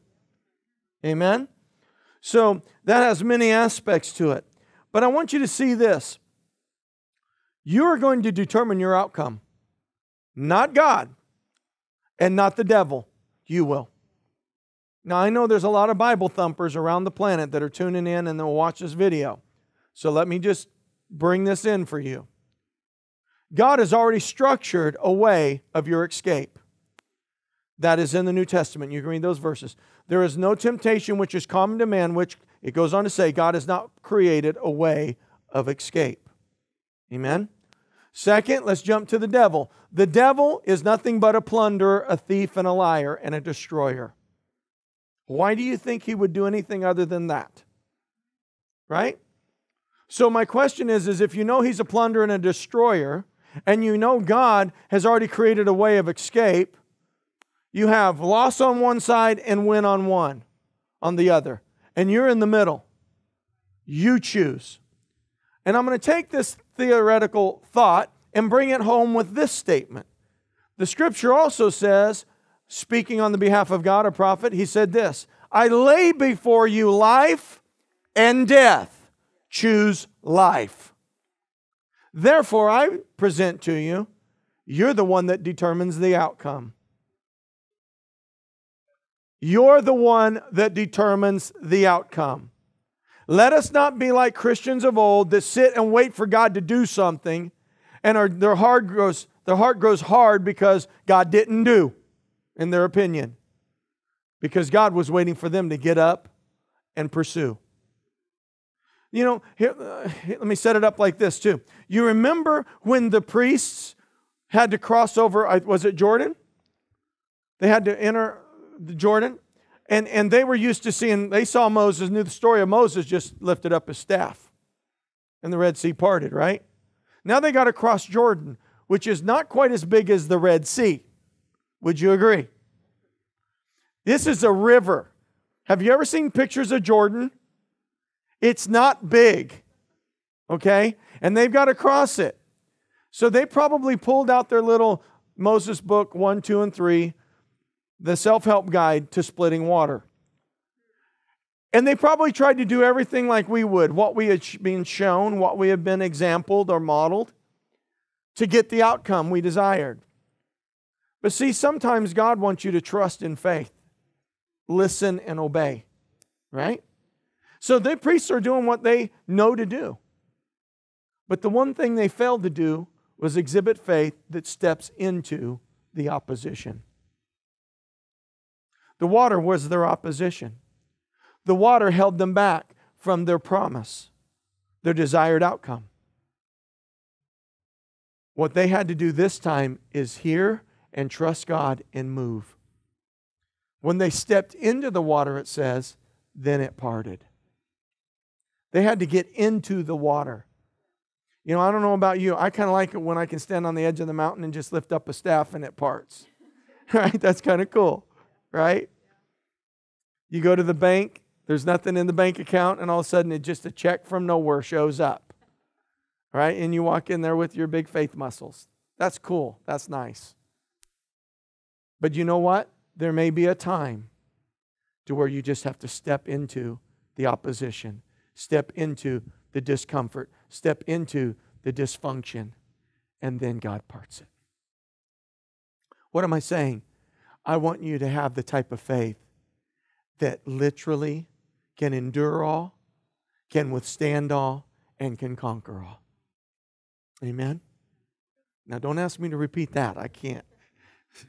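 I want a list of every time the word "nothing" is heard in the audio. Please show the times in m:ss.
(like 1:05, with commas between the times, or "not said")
0:40, 3:31.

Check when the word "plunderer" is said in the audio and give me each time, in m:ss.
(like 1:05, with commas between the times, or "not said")
0:41, 0:51.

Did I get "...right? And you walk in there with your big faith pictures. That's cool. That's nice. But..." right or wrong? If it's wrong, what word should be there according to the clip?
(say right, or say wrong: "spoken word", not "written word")
wrong: "muscles", not "pictures".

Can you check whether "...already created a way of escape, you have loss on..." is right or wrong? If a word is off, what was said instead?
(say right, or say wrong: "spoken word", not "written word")
right.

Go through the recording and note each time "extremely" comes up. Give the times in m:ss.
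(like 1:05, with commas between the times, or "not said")
not said.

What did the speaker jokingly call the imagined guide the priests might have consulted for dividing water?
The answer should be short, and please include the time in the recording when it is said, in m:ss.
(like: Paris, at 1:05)
self help guide, at 2:28.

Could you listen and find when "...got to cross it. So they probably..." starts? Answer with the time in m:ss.
2:21.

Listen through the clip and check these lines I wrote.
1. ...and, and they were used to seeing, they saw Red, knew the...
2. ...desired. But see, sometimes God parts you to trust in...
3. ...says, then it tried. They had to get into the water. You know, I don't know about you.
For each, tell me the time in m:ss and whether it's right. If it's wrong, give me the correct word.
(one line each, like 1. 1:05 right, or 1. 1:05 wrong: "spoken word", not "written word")
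1. 1:59 wrong: "Moses", not "Red"
2. 2:39 wrong: "wants", not "parts"
3. 3:15 wrong: "parted", not "tried".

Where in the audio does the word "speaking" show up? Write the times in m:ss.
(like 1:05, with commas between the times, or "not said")
1:12.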